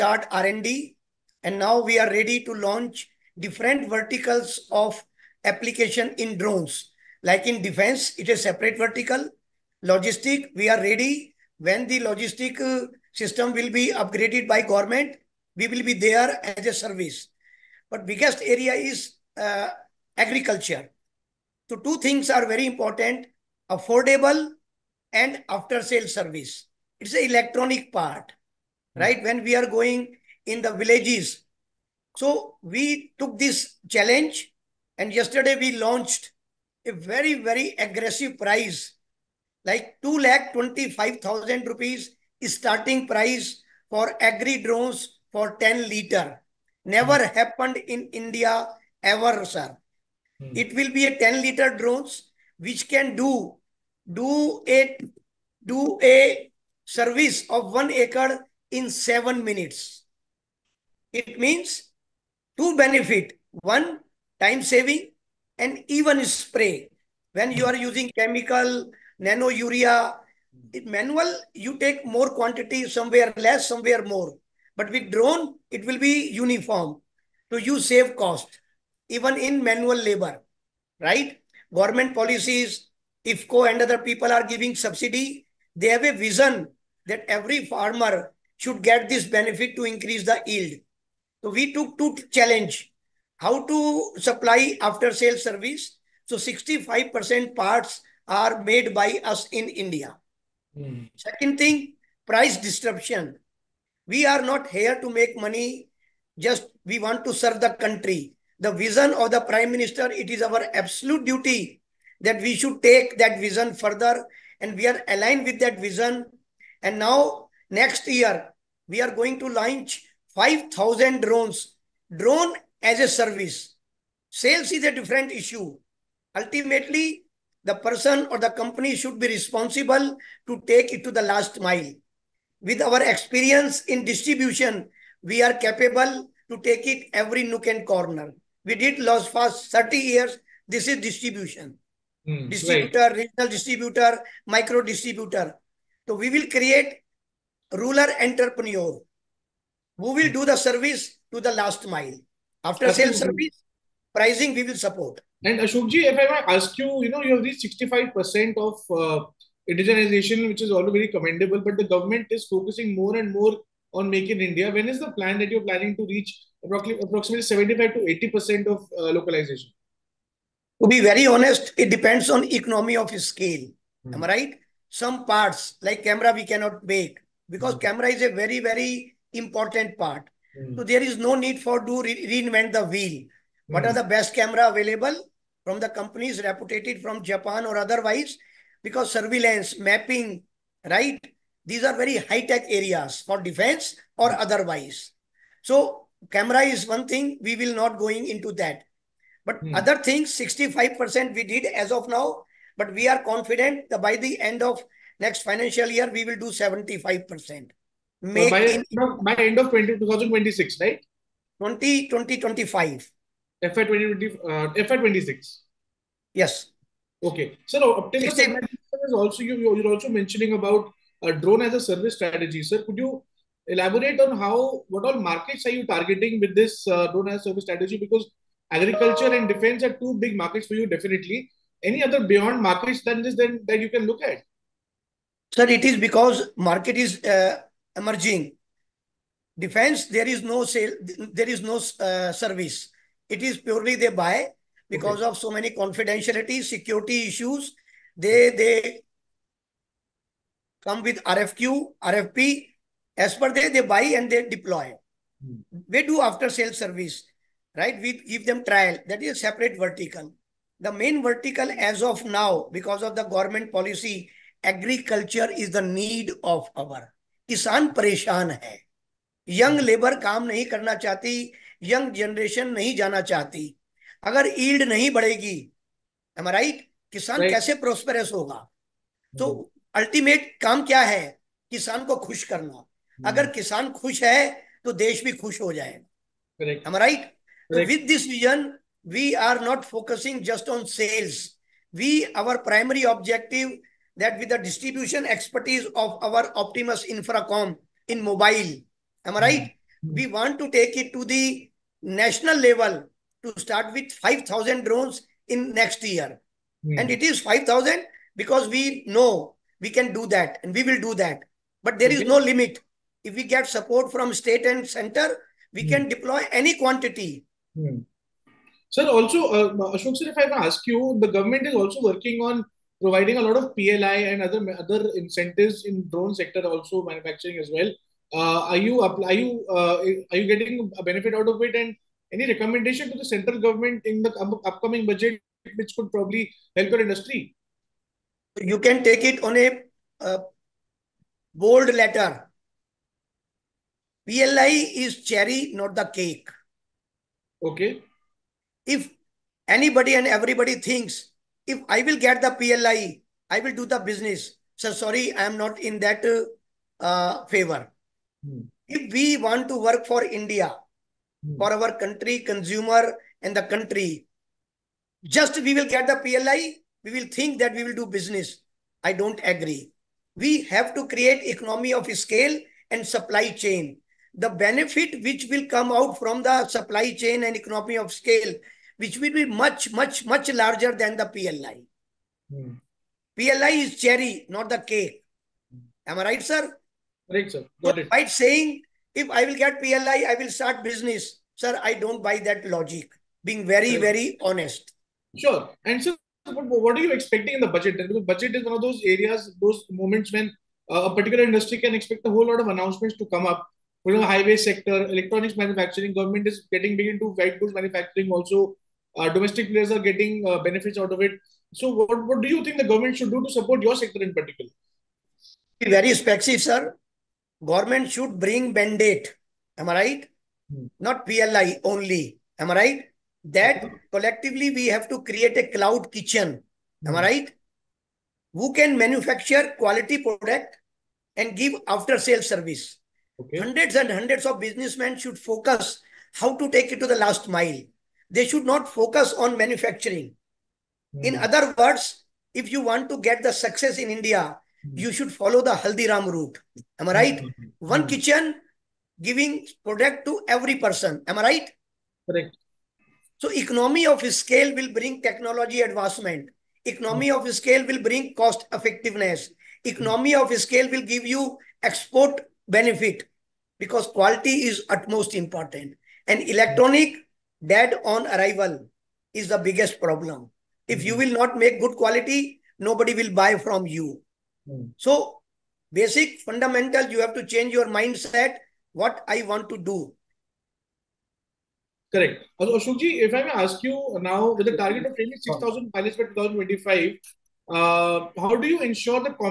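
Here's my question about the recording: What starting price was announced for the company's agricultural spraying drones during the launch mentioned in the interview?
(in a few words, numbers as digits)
2 lakh 25,000 rupees.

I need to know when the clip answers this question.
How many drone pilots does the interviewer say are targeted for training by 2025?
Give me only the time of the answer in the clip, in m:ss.
8:05.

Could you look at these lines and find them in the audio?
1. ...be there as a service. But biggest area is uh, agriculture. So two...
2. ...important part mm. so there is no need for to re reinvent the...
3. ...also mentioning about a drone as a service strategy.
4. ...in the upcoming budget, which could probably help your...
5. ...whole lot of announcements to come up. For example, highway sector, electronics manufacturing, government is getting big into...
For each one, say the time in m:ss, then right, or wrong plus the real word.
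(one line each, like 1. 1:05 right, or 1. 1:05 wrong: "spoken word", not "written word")
1. 0:15 right
2. 2:59 right
3. 3:39 right
4. 5:34 right
5. 6:42 right.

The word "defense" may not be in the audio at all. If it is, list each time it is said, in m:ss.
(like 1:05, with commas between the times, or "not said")
0:07, 3:13, 3:49, 3:59.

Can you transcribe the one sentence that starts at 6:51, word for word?
So, what, what do you think the government should do to support your sector in particular?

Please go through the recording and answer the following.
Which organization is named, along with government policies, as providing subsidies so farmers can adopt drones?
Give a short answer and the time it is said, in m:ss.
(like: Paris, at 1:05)
IFFCO, at 1:23.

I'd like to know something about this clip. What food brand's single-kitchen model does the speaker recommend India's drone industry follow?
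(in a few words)
Haldiram.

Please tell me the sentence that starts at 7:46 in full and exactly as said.
And electronic that on arrival is the biggest problem.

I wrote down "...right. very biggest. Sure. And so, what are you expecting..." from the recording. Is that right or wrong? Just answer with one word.
wrong.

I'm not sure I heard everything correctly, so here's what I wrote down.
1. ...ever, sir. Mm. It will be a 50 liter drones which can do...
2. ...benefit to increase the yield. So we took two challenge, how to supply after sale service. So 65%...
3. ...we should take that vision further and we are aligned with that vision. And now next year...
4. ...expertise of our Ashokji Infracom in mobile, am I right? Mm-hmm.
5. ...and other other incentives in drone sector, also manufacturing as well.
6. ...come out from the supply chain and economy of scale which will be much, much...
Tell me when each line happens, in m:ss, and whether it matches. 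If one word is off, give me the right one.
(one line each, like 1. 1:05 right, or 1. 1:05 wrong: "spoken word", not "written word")
1. 0:49 wrong: "10", not "50"
2. 1:29 right
3. 1:52 right
4. 4:55 wrong: "Optiemus", not "Ashokji"
5. 5:24 right
6. 6:15 right.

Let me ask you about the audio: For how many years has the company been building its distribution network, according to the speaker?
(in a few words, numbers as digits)
30 years.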